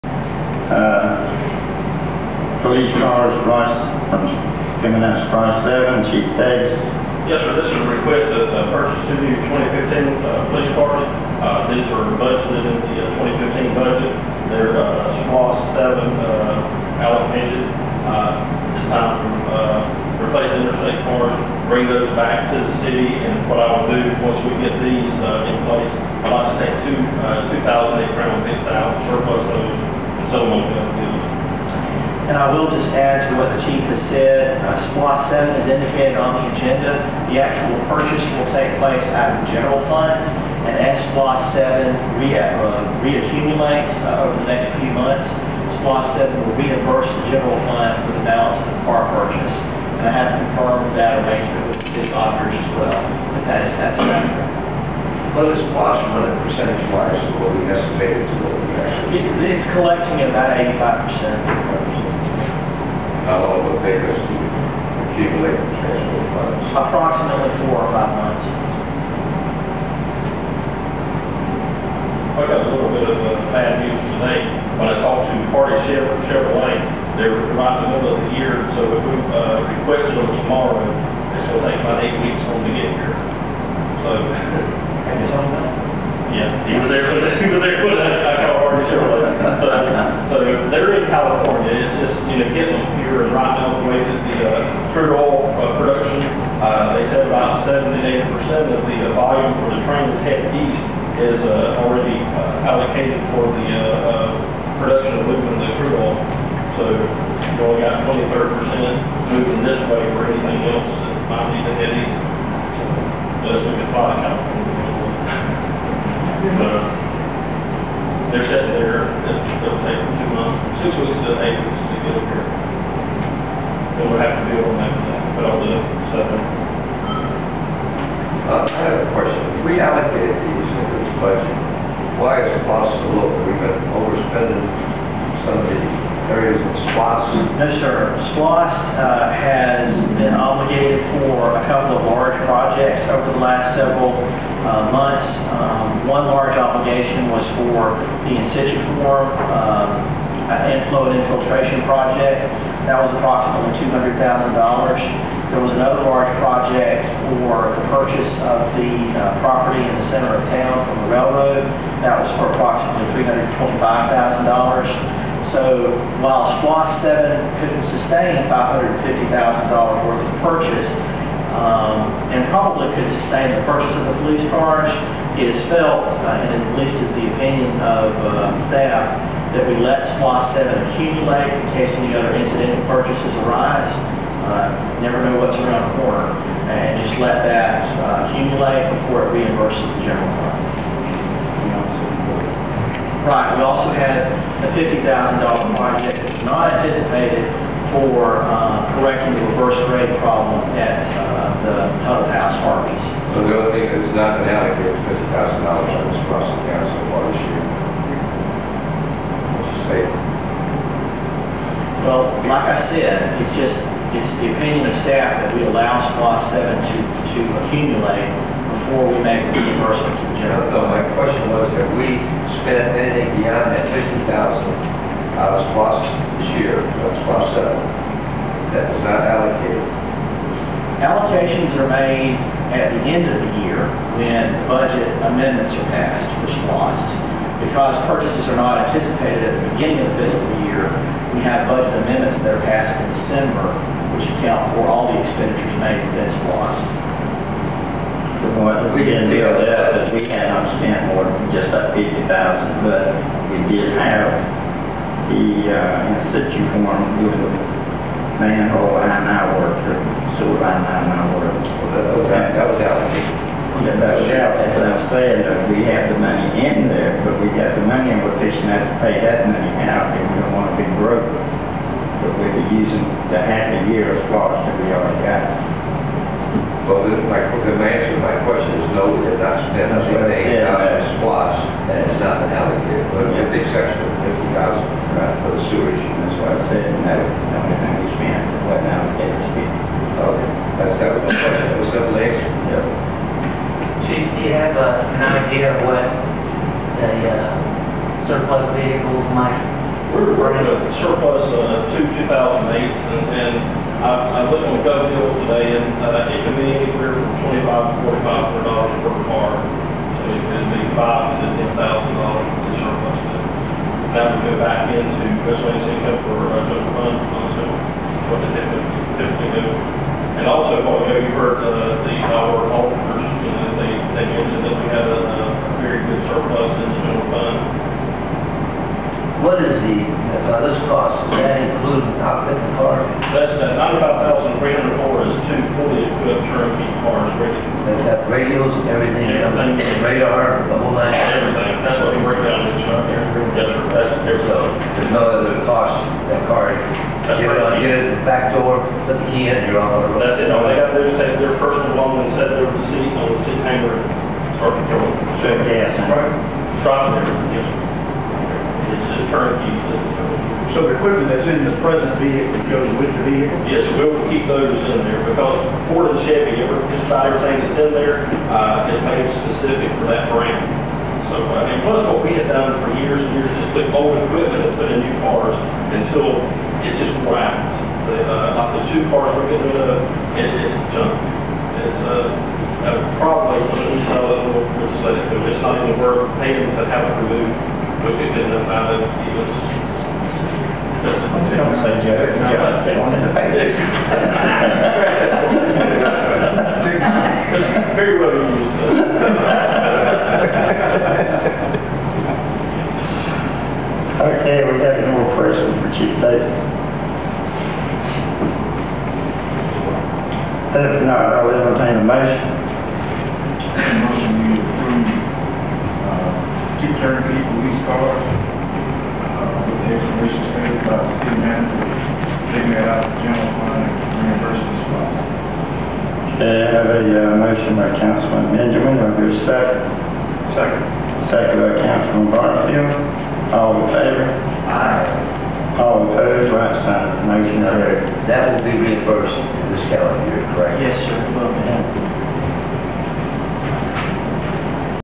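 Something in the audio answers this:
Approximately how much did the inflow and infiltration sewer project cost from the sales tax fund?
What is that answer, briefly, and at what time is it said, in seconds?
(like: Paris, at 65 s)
$200,000, at 153 s.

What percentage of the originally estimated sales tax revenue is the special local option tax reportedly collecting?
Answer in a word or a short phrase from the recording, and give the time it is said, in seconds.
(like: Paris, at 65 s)
85%, at 60 s.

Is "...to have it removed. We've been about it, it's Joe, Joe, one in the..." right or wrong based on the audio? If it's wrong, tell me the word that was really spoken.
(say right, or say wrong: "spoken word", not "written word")
right.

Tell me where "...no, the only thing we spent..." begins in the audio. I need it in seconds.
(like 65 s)
287 s.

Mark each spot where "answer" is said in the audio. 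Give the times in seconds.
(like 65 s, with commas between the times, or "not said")
277 s, 292 s.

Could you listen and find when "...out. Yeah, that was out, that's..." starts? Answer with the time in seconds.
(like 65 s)
262 s.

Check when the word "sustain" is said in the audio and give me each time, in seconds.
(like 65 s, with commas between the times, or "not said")
167 s, 173 s.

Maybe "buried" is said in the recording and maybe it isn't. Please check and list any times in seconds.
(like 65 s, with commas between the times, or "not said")
not said.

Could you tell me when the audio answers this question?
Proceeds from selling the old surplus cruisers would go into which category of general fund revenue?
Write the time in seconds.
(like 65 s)
315 s.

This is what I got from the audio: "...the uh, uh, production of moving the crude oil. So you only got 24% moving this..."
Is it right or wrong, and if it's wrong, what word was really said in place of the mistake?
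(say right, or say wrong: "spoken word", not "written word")
wrong: "23", not "24".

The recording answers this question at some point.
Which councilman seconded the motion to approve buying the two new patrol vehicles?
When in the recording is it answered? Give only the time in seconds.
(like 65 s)
431 s.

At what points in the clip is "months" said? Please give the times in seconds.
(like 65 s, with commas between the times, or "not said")
44 s, 68 s, 120 s, 144 s.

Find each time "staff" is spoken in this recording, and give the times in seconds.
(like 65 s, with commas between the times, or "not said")
178 s, 215 s.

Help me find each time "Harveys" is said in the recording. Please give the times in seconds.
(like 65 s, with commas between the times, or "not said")
202 s.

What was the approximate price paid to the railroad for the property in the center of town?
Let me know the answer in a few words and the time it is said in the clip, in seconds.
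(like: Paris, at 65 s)
$325,000, at 163 s.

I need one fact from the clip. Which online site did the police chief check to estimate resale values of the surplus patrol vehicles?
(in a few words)
GovDeal.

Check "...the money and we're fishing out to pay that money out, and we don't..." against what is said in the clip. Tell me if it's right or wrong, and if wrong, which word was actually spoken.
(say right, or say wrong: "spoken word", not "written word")
right.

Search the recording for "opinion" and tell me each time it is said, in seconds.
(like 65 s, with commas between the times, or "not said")
177 s, 214 s.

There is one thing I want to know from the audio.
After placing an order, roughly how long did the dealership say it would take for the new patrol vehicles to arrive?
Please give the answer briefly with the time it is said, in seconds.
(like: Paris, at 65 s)
8 weeks, at 82 s.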